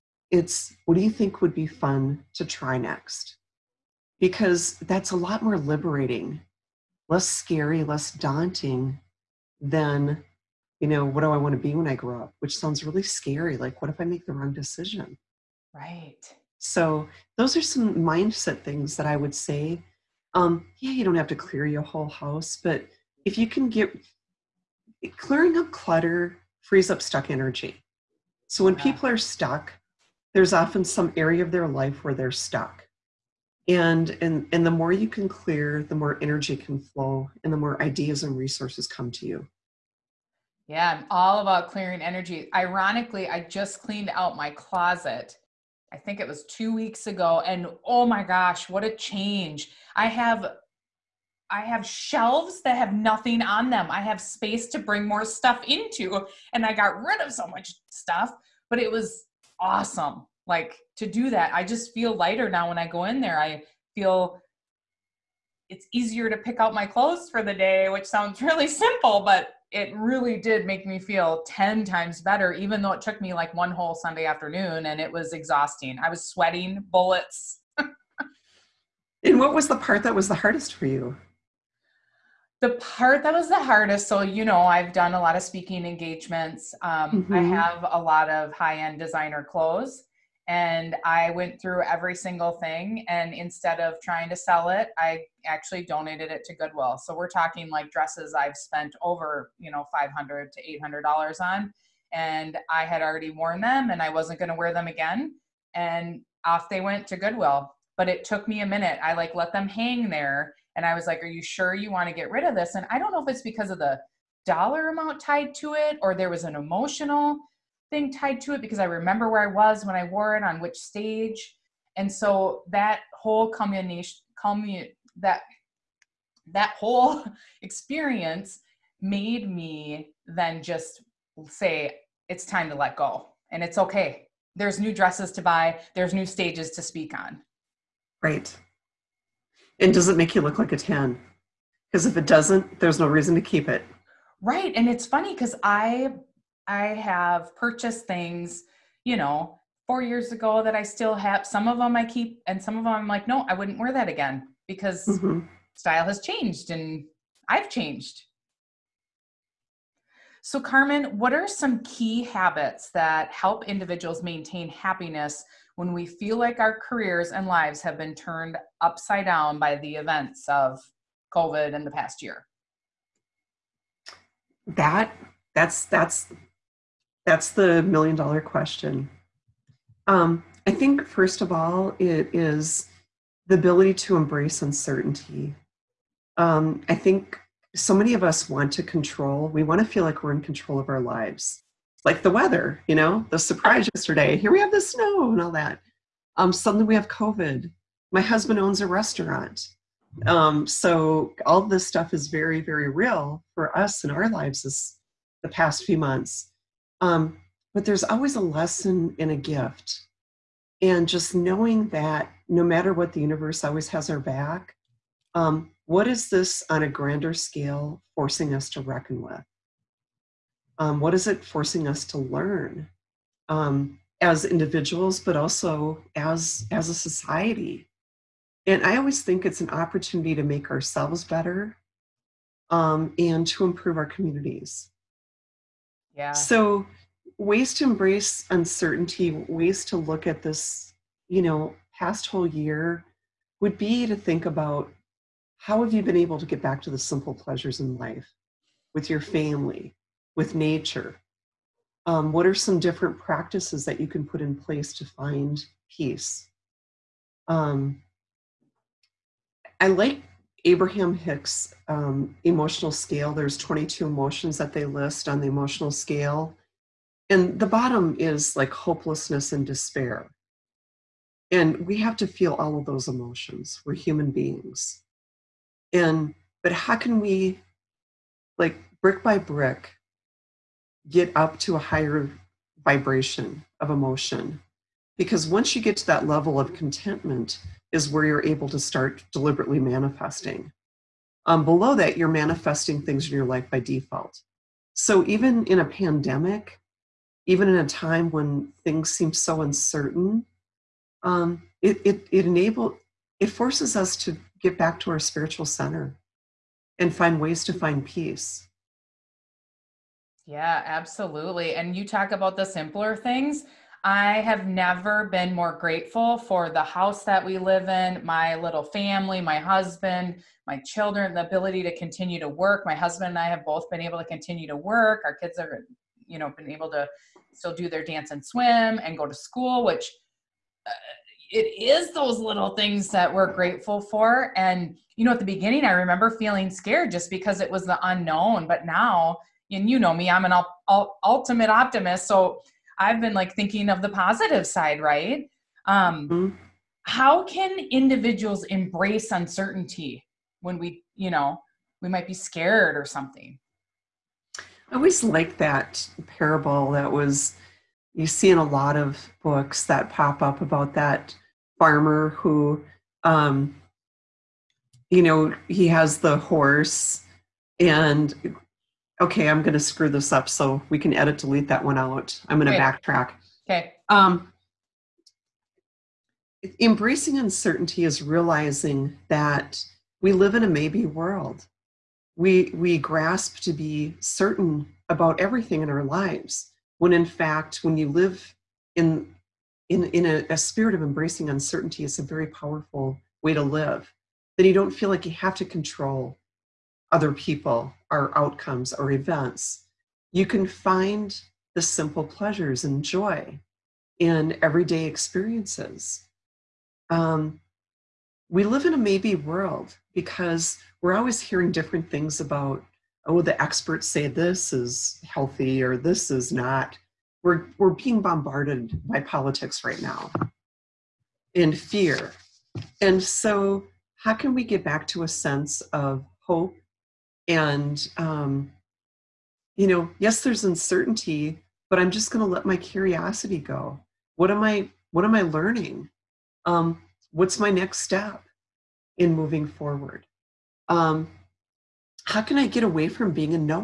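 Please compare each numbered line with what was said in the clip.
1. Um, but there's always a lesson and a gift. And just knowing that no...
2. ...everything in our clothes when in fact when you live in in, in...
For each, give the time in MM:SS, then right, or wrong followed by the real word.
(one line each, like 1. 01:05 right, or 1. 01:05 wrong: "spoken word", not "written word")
1. 03:26 right
2. 06:25 wrong: "lives", not "clothes".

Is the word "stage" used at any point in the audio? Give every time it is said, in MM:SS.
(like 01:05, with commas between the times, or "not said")
02:00, 02:16.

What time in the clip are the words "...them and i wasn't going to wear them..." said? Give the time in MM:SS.
01:43.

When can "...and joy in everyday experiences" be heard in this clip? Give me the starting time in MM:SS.
06:42.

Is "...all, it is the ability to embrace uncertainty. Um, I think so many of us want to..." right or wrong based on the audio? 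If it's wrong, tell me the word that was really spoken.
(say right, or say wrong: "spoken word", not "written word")
right.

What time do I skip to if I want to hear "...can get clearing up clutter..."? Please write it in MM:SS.
00:23.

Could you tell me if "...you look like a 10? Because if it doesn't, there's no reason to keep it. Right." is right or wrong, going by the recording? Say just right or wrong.
right.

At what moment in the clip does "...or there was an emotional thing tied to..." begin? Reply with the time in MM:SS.
01:56.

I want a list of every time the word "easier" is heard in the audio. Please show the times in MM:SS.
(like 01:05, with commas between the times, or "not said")
01:05.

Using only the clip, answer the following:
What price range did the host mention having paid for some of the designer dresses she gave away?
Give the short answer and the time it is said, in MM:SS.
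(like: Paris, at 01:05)
$500 to $800, at 01:39.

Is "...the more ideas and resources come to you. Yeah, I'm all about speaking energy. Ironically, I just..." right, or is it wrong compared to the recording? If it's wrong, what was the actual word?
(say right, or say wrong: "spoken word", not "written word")
wrong: "clearing", not "speaking".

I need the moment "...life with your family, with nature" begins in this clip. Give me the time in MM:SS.
04:07.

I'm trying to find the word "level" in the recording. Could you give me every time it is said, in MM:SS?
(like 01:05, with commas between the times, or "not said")
04:46.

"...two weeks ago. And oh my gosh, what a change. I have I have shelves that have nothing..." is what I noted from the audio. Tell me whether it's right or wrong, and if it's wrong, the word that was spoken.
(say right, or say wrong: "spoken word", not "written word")
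right.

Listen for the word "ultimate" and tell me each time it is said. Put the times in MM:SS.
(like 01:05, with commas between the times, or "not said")
05:41.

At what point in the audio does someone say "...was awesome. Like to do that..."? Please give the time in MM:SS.
00:58.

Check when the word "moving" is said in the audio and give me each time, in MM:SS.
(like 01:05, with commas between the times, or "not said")
07:19.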